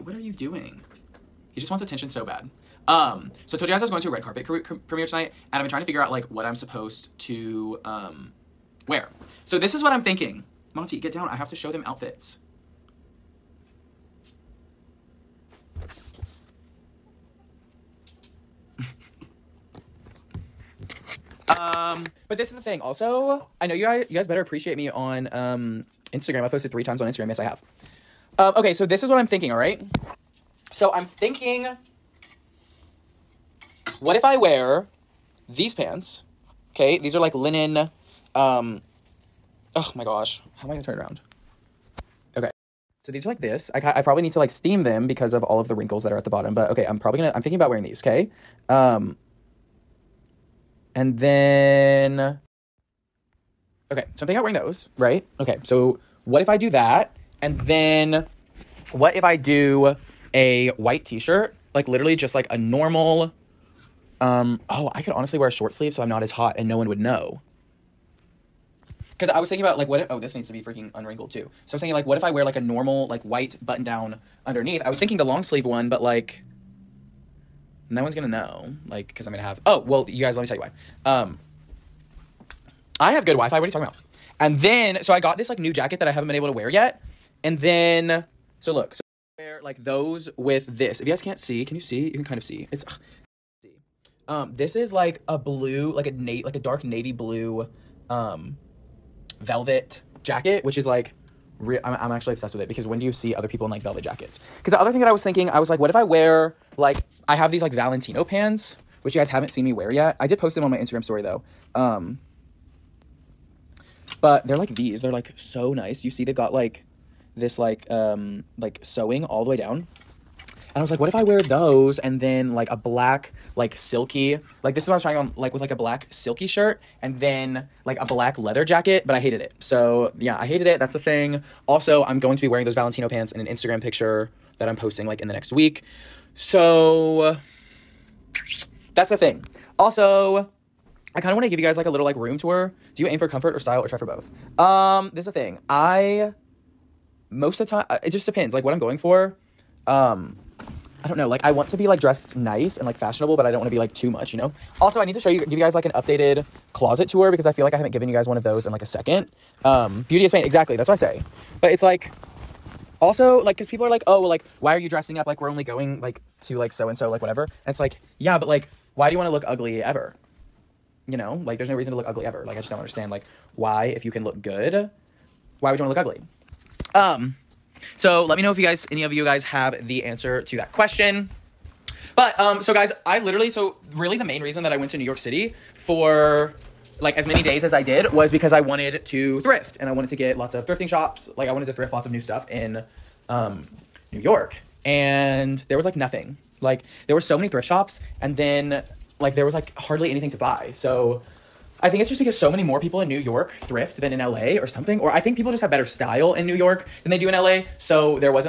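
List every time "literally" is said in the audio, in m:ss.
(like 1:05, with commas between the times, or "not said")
1:01, 3:03.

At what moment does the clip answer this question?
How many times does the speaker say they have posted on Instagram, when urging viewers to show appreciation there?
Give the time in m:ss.
0:26.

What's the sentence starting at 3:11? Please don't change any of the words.
Like I wanted to thrift lots of new stuff in um, New York.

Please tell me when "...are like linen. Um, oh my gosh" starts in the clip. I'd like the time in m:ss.
0:37.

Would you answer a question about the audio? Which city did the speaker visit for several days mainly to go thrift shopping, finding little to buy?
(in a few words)
New York City.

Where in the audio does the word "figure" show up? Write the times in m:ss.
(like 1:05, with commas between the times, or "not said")
0:05.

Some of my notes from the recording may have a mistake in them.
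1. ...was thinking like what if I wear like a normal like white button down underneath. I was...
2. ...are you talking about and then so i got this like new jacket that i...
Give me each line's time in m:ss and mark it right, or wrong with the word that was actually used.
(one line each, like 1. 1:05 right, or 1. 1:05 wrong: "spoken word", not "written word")
1. 1:11 right
2. 1:23 right.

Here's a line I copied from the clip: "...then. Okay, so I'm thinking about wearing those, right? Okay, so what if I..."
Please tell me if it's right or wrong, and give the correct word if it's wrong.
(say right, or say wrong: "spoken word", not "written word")
right.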